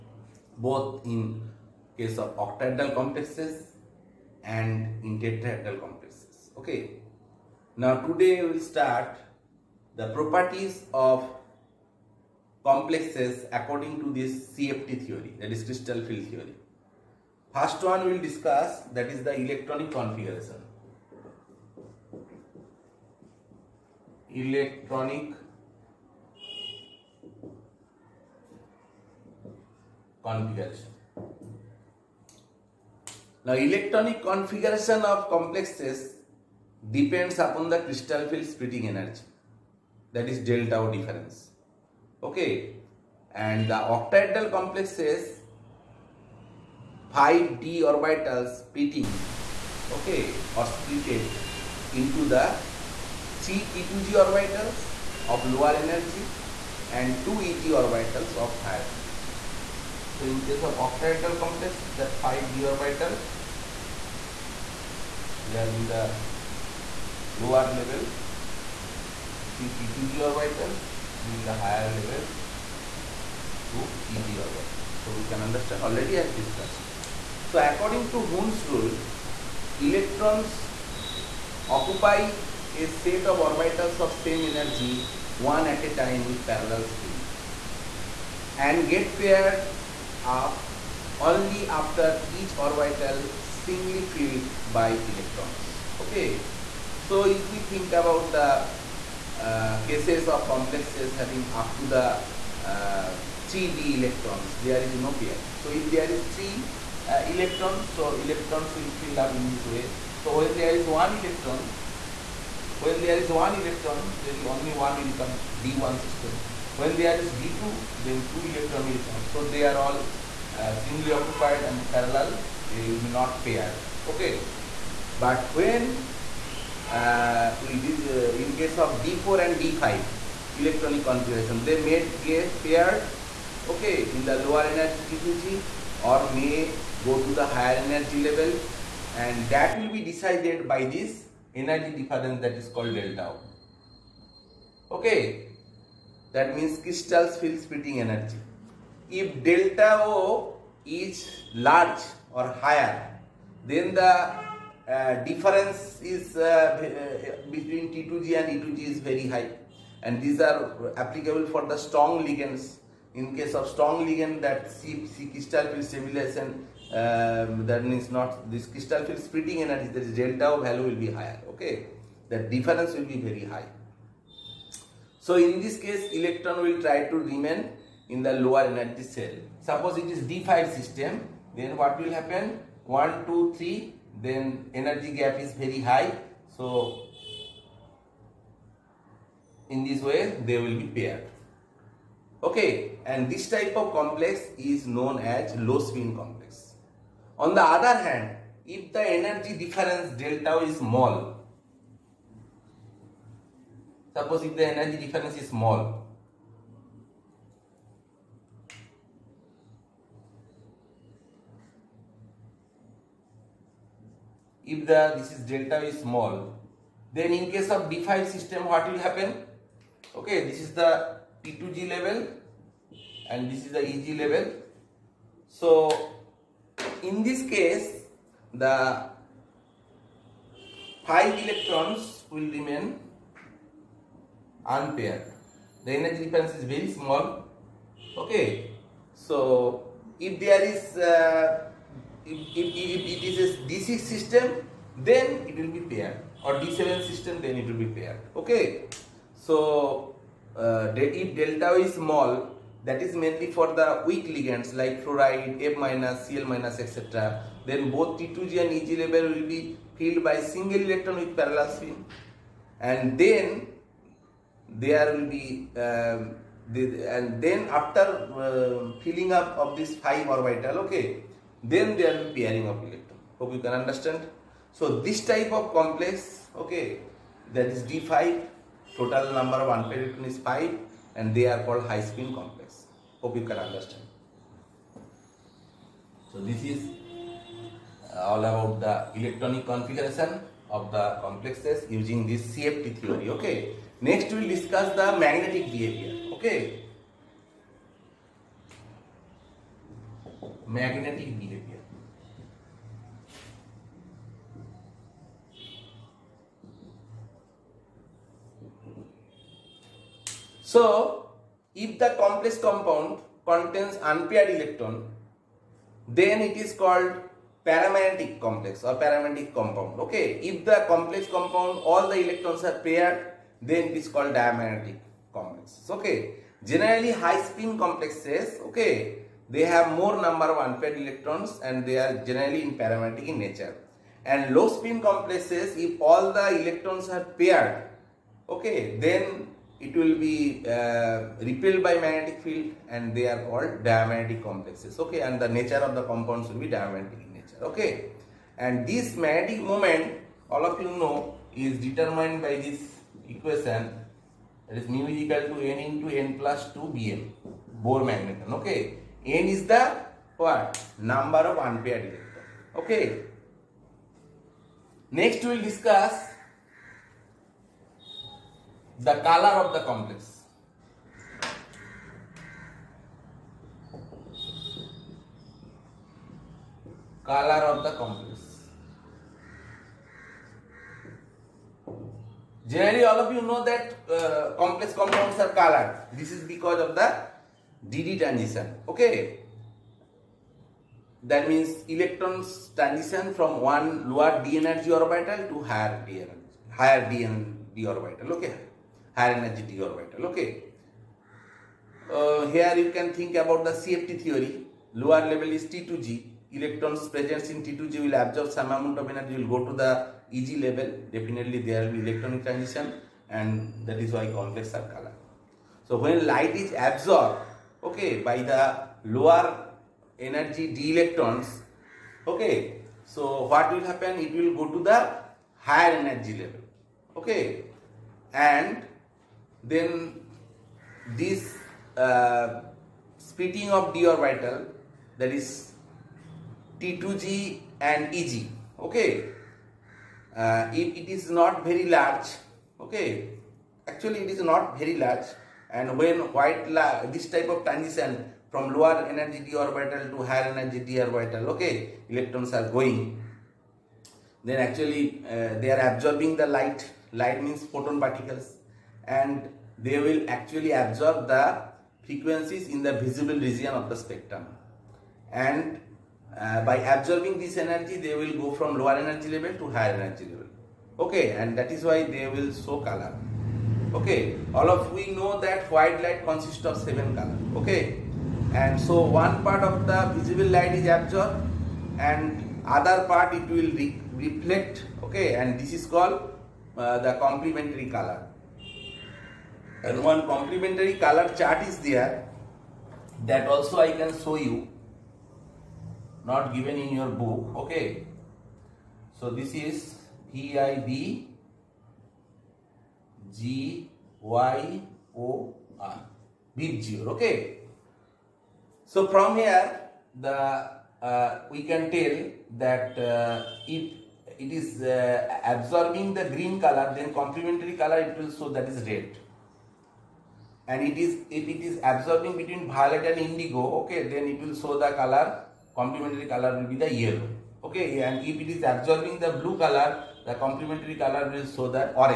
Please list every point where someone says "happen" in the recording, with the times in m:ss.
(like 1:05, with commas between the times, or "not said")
3:02, 3:39, 7:03.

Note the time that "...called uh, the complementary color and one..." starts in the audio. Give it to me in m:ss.
8:05.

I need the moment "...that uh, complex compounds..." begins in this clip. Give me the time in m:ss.
6:23.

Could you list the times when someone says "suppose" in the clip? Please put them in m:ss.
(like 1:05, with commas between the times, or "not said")
2:59, 3:24.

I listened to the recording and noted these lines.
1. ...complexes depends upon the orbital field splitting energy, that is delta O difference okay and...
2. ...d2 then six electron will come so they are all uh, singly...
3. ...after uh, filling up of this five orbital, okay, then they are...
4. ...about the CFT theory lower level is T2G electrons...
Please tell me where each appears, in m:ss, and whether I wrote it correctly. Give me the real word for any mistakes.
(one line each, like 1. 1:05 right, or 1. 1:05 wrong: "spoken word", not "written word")
1. 0:35 wrong: "crystal", not "orbital"
2. 1:57 wrong: "two", not "six"
3. 4:27 right
4. 6:43 right.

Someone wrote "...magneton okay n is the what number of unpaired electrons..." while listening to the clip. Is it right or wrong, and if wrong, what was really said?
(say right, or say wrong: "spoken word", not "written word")
right.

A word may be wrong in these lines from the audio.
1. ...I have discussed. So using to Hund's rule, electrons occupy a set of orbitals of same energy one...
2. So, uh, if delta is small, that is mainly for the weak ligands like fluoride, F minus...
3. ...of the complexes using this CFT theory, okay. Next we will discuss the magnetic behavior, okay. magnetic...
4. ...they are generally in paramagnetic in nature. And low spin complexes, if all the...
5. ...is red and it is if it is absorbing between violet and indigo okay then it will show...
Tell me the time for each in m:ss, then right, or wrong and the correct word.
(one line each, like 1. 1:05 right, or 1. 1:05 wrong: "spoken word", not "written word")
1. 1:16 wrong: "according", not "using"
2. 4:09 right
3. 4:50 right
4. 5:31 right
5. 8:38 right.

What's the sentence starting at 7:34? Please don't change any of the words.
Then actually uh, they are absorbing the light.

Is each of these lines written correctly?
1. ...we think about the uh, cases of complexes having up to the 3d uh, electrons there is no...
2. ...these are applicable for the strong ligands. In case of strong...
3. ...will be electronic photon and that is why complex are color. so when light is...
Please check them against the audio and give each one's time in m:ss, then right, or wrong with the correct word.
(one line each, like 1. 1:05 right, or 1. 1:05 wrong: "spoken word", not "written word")
1. 1:37 right
2. 2:40 right
3. 6:51 wrong: "transition", not "photon".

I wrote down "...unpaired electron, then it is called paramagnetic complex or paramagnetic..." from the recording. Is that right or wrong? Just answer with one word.
right.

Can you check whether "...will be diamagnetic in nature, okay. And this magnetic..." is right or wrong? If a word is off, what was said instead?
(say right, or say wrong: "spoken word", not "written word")
right.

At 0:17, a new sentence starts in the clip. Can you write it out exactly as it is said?
First one we will discuss, that is the electronic configuration.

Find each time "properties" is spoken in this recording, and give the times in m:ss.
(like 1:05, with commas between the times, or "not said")
0:10.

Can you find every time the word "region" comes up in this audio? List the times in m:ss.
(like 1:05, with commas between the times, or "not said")
7:43.